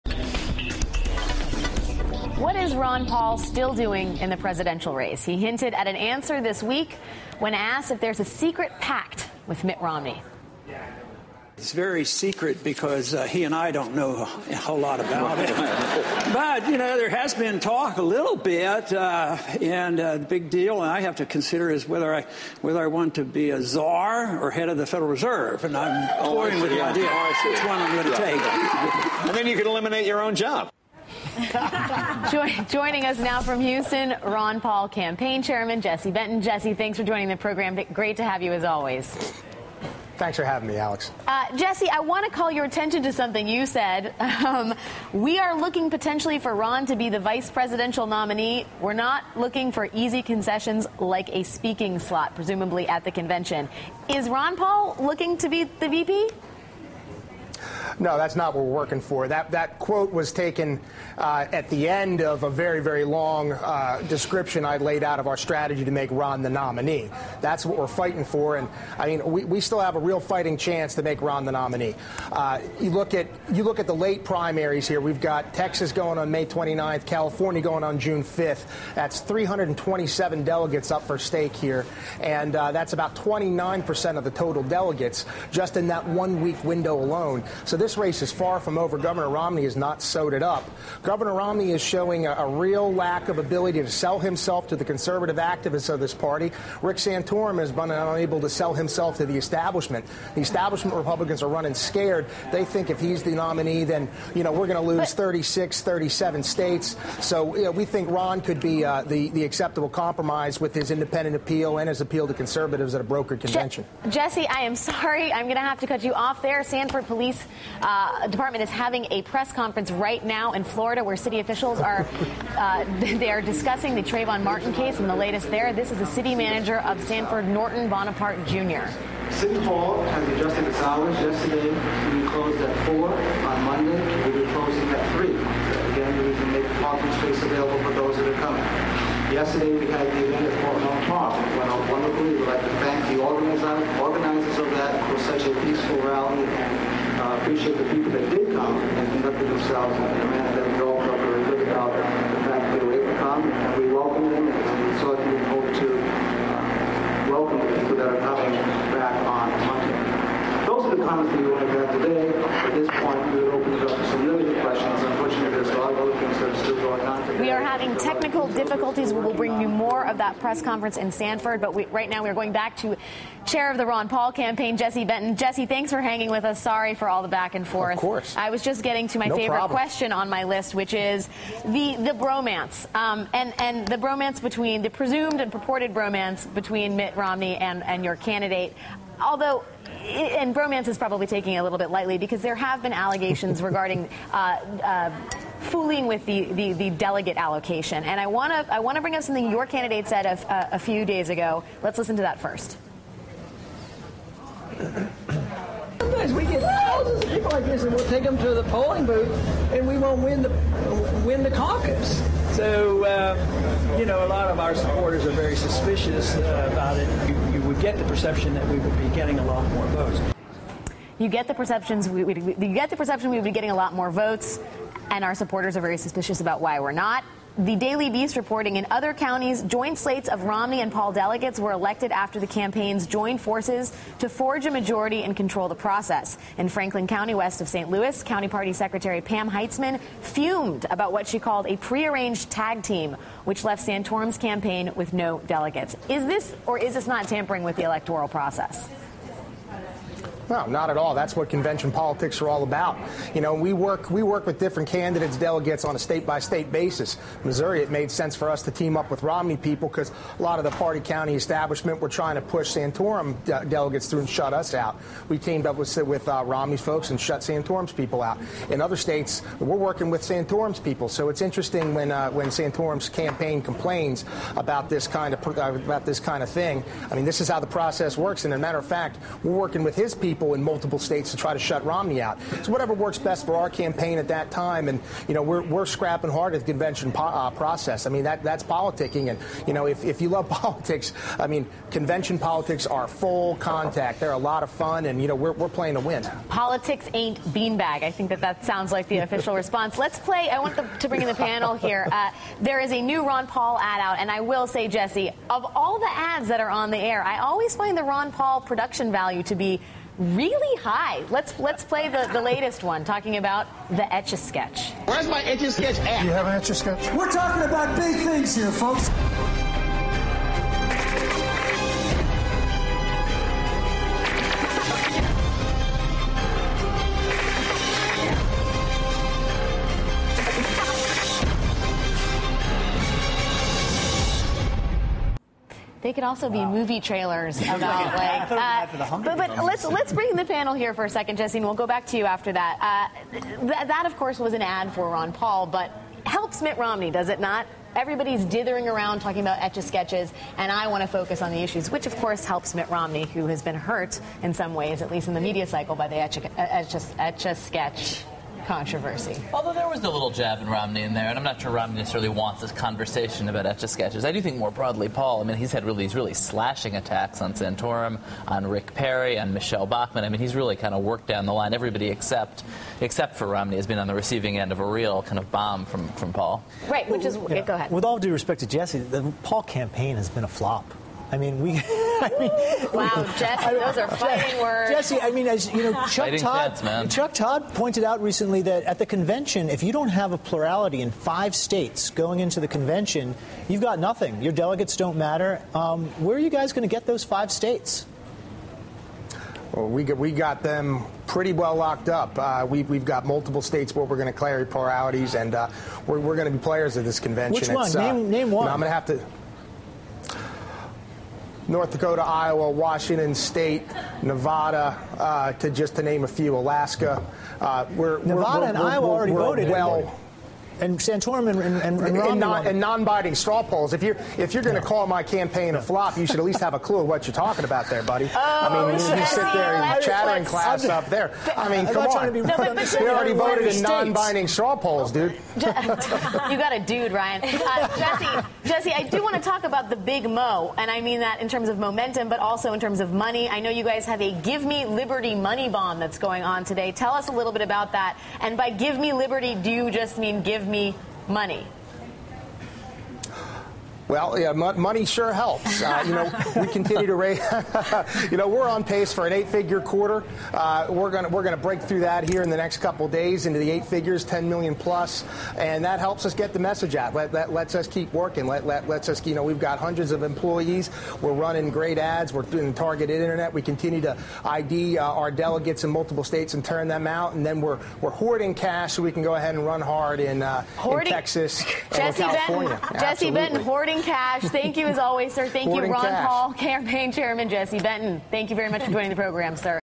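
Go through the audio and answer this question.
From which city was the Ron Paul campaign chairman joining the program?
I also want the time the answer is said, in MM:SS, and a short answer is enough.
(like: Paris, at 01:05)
Houston, at 00:33.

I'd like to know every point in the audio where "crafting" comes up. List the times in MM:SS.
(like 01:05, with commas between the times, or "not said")
not said.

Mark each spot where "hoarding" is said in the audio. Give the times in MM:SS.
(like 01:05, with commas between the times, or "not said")
07:58, 08:03.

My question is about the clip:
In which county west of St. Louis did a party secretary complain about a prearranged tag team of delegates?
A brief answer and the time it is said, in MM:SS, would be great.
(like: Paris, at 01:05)
Franklin County, at 03:56.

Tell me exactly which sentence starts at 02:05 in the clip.
This is the city manager of Sanford Norton Bonaparte Jr.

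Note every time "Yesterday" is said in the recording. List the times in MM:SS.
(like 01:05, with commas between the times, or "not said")
02:11, 02:19.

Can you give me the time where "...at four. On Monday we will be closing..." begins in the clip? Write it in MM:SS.
02:12.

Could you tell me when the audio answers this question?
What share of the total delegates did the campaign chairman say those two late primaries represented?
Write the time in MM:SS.
01:23.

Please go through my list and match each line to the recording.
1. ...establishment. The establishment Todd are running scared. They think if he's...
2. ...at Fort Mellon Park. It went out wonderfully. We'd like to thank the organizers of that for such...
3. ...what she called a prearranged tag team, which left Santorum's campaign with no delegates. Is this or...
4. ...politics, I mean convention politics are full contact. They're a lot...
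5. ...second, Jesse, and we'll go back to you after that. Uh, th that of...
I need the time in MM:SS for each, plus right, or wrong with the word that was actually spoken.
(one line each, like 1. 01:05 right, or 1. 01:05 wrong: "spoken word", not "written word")
1. 01:39 wrong: "Republicans", not "Todd"
2. 02:20 right
3. 04:01 right
4. 04:50 right
5. 05:41 right.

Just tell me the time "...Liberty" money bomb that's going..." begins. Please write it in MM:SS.
07:24.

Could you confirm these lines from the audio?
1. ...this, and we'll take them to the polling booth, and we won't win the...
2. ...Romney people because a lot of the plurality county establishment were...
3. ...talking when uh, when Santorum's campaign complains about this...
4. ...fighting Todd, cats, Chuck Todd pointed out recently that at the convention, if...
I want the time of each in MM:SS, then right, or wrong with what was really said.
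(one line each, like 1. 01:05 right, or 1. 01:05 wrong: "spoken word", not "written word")
1. 03:27 right
2. 04:19 wrong: "party", not "plurality"
3. 04:31 wrong: "interesting", not "talking"
4. 06:26 right.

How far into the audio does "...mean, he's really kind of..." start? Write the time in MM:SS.
06:10.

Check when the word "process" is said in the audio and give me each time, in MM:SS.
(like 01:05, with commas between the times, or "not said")
03:55, 04:08, 04:37, 04:47.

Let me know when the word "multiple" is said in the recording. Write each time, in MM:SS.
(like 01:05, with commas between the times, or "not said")
04:40, 06:43, 07:55.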